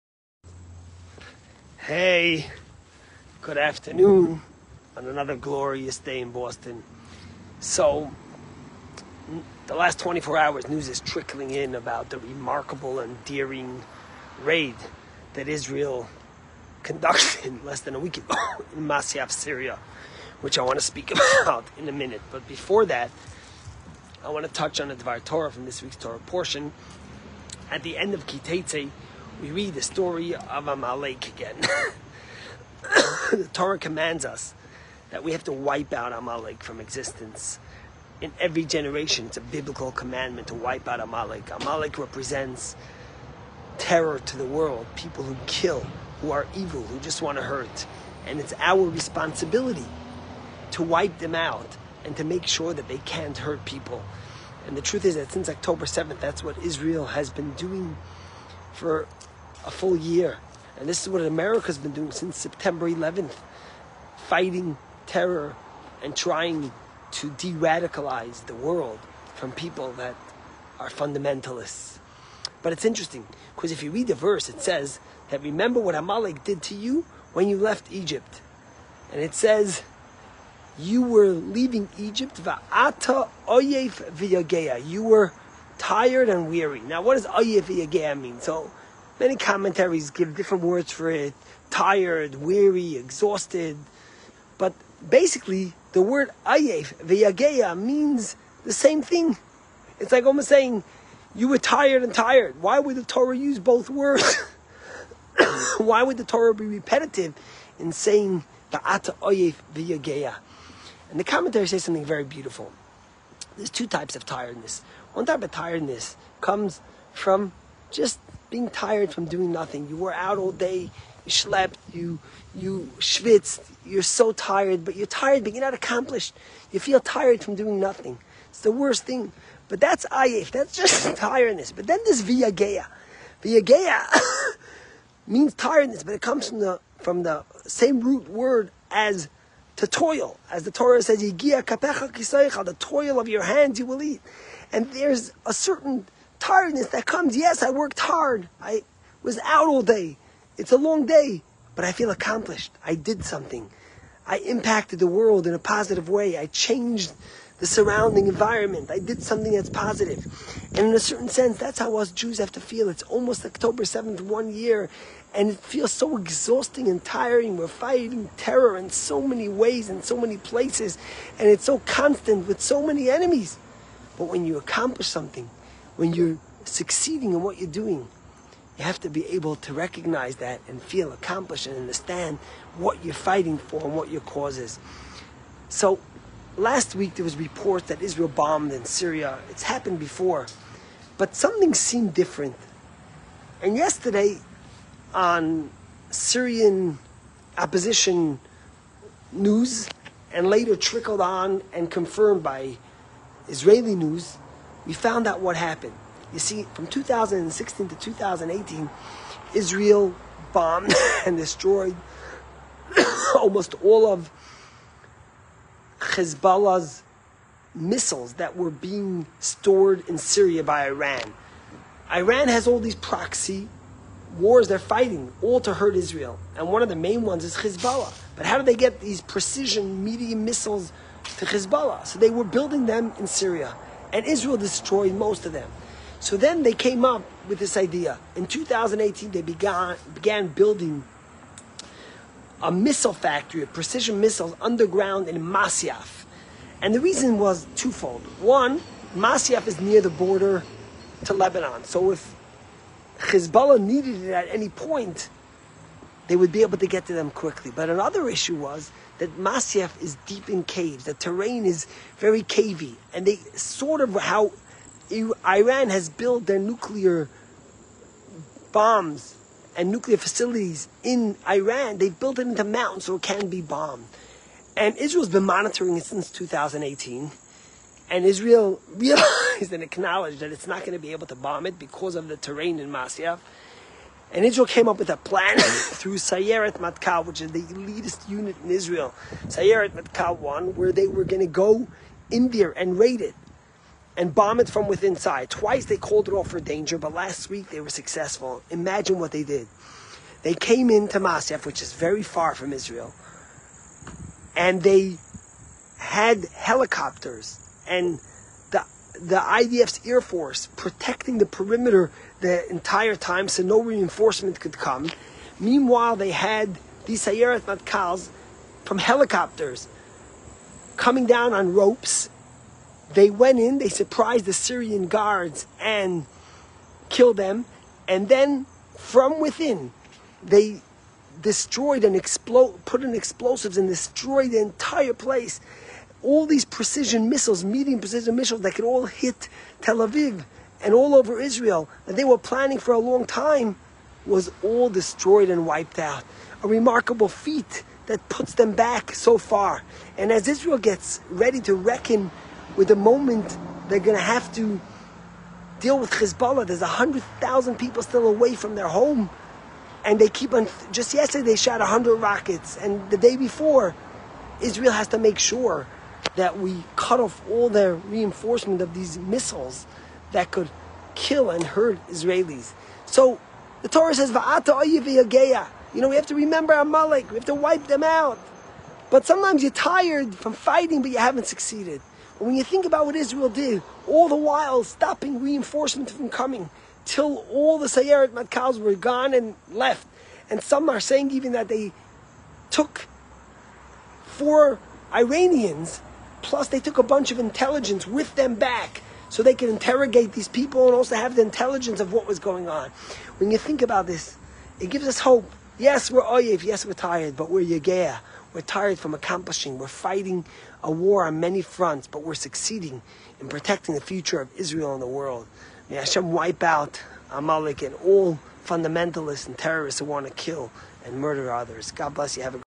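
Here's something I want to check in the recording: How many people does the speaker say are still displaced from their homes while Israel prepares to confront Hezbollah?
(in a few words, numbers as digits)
100,000.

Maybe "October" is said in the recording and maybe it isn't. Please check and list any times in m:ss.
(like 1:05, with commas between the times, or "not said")
0:55, 2:43.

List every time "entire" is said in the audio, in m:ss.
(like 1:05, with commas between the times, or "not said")
5:12, 5:34.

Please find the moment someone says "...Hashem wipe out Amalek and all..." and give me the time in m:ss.
6:55.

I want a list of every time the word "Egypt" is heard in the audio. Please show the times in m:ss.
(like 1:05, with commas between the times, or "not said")
1:17, 1:21.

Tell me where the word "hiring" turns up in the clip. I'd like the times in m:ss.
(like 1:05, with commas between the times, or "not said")
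not said.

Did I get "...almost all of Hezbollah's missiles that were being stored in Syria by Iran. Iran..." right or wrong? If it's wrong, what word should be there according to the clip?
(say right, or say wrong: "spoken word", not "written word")
right.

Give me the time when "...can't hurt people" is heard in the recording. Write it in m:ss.
0:52.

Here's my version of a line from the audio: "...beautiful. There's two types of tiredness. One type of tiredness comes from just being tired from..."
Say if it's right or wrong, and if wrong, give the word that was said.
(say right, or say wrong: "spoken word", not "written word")
right.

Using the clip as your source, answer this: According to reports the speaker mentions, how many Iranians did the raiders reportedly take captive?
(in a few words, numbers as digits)
4.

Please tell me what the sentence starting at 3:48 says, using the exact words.
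But how do they get these precision medium missiles to Hezbollah?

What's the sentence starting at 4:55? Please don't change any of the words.
Twice they called it off for danger, but last week they were successful.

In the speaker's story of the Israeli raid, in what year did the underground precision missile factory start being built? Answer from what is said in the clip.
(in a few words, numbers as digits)
2018.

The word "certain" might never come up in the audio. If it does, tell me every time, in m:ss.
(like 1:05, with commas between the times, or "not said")
2:25, 2:40.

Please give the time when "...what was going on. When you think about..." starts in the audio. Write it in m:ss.
6:42.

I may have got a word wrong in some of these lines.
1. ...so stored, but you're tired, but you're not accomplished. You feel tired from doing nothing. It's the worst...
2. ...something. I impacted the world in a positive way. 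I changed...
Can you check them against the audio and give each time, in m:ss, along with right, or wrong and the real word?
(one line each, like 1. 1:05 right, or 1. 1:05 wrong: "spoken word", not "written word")
1. 2:04 wrong: "tired", not "stored"
2. 2:33 right.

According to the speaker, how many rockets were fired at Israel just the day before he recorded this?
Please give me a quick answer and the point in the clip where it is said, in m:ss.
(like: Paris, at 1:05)
100, at 6:01.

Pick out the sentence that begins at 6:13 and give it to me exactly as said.
So the Torah says, Va'ata You know, we have to remember Amalek, we have to wipe them out.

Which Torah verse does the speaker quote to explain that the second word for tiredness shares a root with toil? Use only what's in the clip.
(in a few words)
the toil of your hands you will eat.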